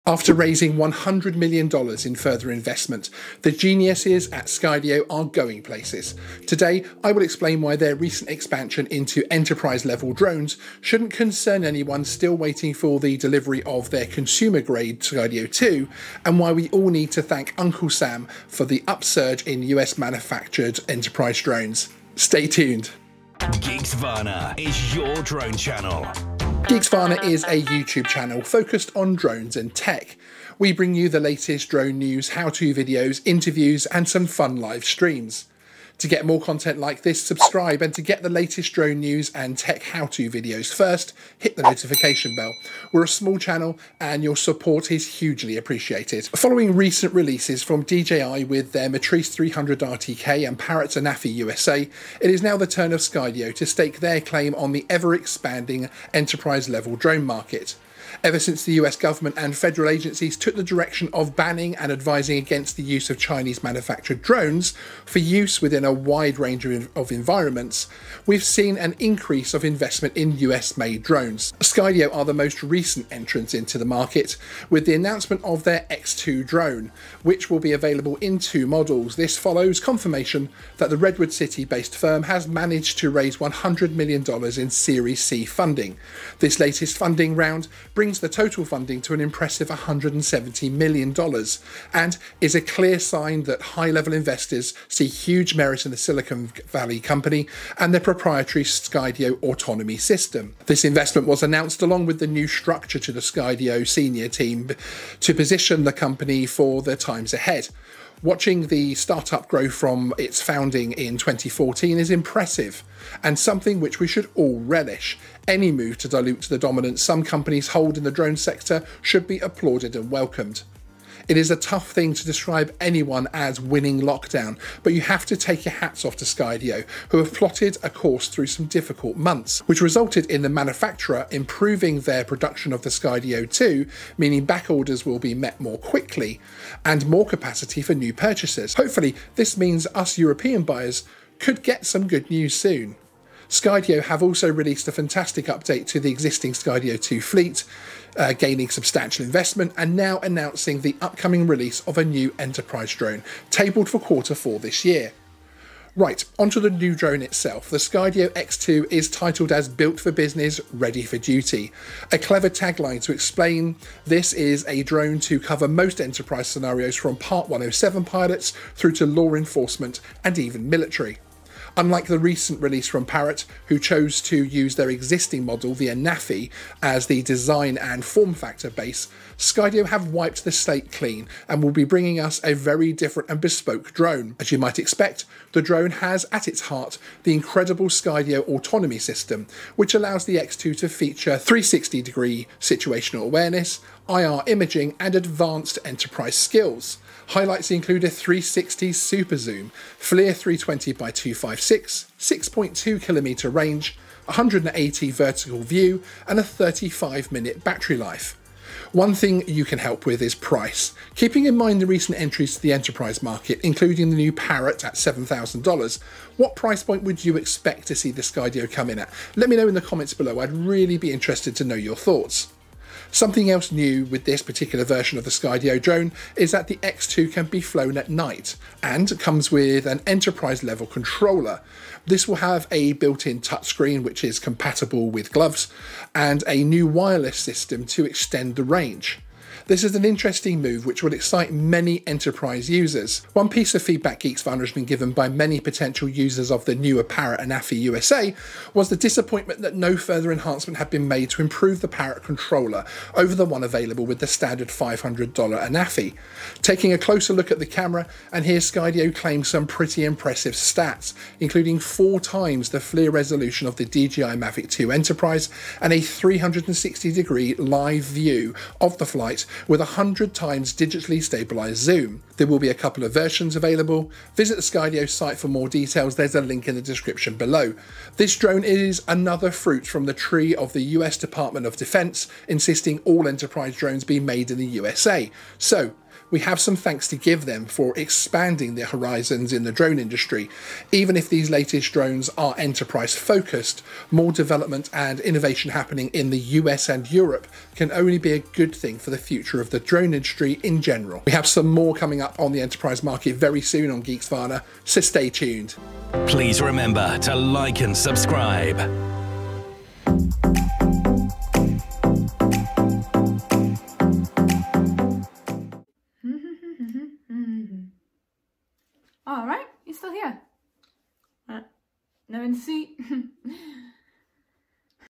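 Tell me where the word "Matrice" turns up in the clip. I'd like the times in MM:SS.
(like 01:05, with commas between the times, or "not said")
00:48.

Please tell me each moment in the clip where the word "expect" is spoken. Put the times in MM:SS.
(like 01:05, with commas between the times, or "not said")
03:04, 03:37.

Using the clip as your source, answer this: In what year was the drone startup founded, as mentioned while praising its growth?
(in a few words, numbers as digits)
2014.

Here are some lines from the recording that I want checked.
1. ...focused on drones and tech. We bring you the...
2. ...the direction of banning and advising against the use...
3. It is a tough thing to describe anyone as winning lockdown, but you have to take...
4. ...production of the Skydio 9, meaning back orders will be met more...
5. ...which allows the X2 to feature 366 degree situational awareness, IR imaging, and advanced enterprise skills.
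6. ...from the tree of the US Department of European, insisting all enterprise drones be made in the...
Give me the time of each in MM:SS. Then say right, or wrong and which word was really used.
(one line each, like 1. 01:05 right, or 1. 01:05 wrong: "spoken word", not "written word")
1. 00:28 right
2. 01:00 right
3. 02:01 right
4. 02:12 wrong: "2", not "9"
5. 03:09 wrong: "360", not "366"
6. 04:39 wrong: "Defense", not "European".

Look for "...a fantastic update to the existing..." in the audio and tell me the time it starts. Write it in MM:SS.
02:24.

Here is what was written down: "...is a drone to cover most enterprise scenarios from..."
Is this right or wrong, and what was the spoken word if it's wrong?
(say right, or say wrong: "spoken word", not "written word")
right.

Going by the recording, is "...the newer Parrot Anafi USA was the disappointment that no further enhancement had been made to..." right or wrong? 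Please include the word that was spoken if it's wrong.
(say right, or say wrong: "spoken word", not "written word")
right.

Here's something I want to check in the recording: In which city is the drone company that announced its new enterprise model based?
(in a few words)
Redwood City.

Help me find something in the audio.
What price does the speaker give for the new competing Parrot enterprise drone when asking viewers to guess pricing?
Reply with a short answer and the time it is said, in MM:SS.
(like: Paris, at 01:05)
$7,000, at 03:34.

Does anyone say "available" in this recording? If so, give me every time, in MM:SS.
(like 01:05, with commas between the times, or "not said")
01:17, 04:13, 04:33.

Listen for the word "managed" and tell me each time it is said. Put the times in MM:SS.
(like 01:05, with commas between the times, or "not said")
01:22.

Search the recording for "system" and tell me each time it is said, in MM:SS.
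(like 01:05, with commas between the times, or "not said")
01:39, 03:08, 03:57.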